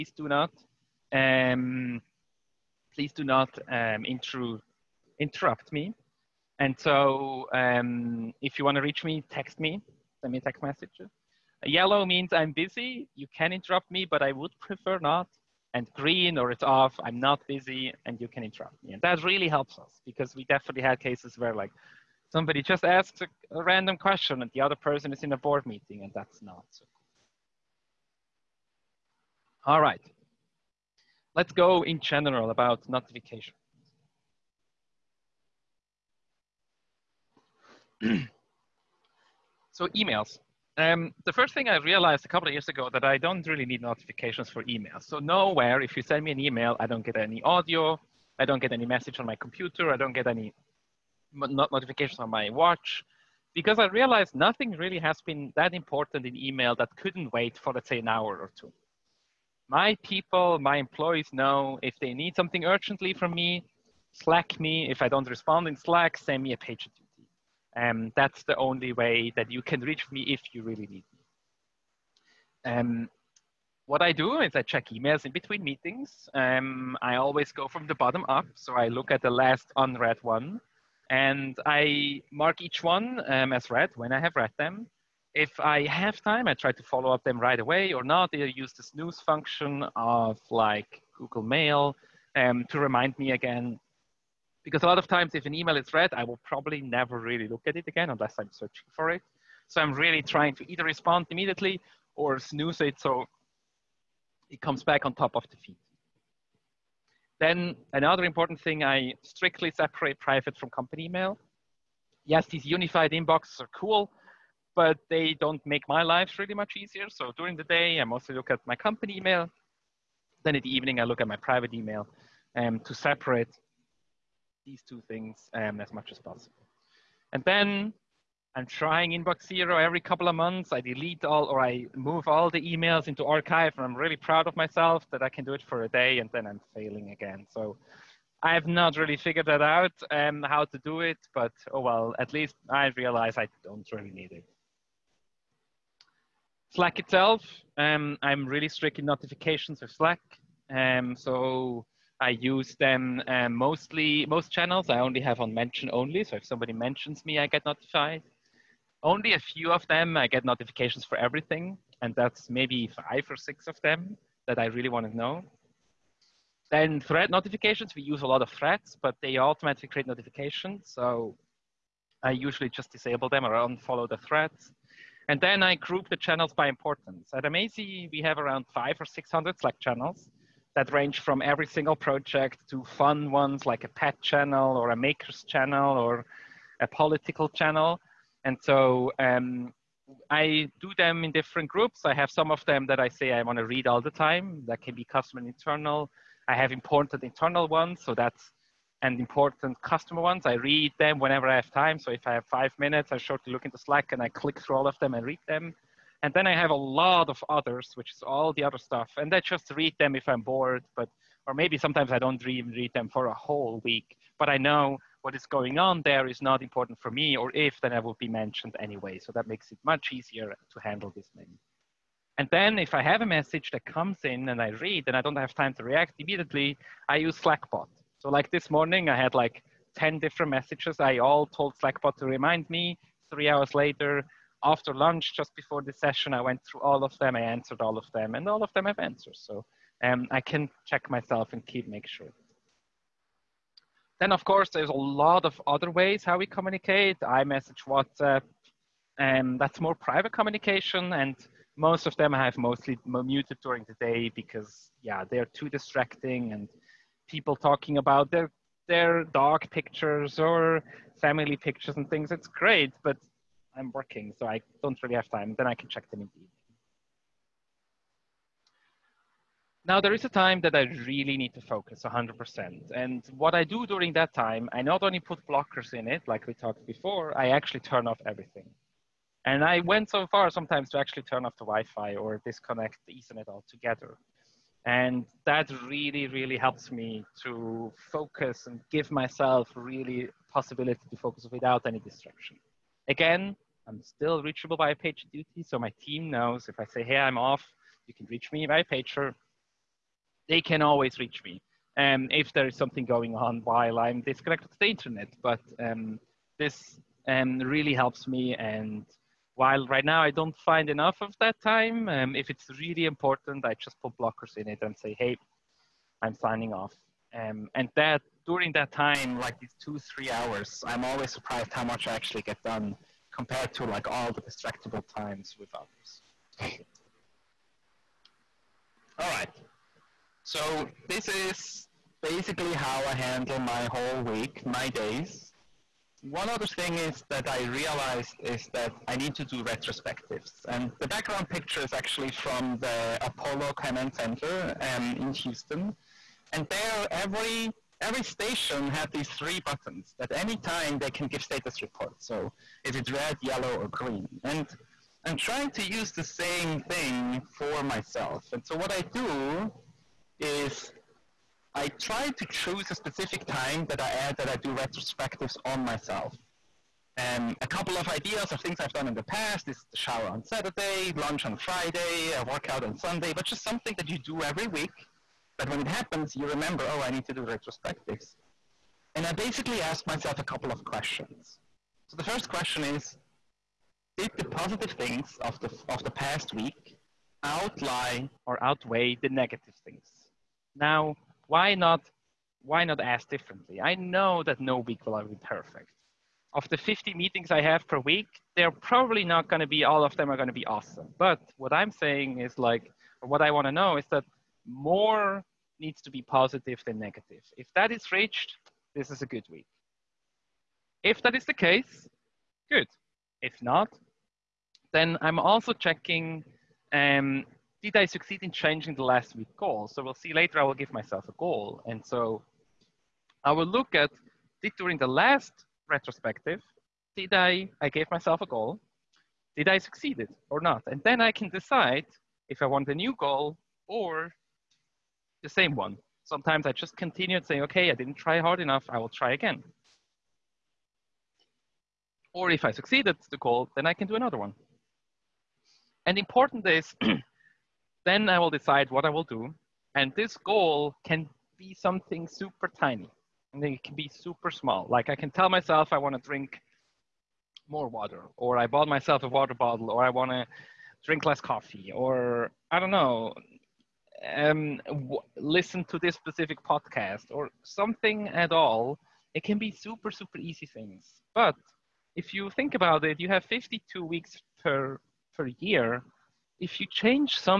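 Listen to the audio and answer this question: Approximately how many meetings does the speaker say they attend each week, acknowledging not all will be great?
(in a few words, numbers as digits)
50.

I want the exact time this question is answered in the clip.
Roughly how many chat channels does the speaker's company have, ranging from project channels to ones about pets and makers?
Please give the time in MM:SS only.
02:58.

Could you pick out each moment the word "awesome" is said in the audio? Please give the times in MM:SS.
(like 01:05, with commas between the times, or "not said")
06:40.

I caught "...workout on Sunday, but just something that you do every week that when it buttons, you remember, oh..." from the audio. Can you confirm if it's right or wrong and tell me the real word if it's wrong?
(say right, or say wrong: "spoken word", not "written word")
wrong: "happens", not "buttons".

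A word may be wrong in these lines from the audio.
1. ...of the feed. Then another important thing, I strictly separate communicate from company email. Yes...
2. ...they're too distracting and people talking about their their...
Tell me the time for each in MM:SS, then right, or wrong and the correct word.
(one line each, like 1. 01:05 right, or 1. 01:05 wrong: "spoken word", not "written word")
1. 01:45 wrong: "private", not "communicate"
2. 04:15 right.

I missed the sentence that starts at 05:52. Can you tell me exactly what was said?
So is it red, yellow, or green?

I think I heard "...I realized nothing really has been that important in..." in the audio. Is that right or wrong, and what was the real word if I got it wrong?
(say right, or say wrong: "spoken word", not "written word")
right.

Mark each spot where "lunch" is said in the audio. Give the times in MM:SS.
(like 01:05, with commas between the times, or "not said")
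03:54, 06:11.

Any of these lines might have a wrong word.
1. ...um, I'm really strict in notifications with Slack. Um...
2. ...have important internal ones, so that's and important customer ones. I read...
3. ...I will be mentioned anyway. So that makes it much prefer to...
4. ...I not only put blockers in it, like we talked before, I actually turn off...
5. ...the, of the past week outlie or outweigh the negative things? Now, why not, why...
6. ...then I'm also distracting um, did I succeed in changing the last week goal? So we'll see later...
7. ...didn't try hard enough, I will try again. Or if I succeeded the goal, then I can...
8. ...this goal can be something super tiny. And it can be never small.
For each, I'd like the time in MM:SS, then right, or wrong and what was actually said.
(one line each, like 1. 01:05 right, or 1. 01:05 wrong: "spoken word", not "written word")
1. 02:27 right
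2. 03:16 right
3. 03:37 wrong: "easier", not "prefer"
4. 04:34 right
5. 06:25 right
6. 06:54 wrong: "checking", not "distracting"
7. 07:17 right
8. 07:30 wrong: "super", not "never".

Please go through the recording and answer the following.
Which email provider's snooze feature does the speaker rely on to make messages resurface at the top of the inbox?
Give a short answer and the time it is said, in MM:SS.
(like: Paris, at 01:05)
Google Mail, at 01:31.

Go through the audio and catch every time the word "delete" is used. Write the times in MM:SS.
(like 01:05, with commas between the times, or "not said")
02:10.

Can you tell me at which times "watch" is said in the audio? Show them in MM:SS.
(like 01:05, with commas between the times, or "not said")
00:52.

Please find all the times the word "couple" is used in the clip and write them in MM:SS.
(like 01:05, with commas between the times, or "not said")
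00:42, 02:09, 06:07, 06:20.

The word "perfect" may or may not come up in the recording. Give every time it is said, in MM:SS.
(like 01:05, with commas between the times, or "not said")
06:35.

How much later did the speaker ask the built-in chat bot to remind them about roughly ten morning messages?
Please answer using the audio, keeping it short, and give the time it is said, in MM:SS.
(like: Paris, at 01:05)
3 hours, at 03:53.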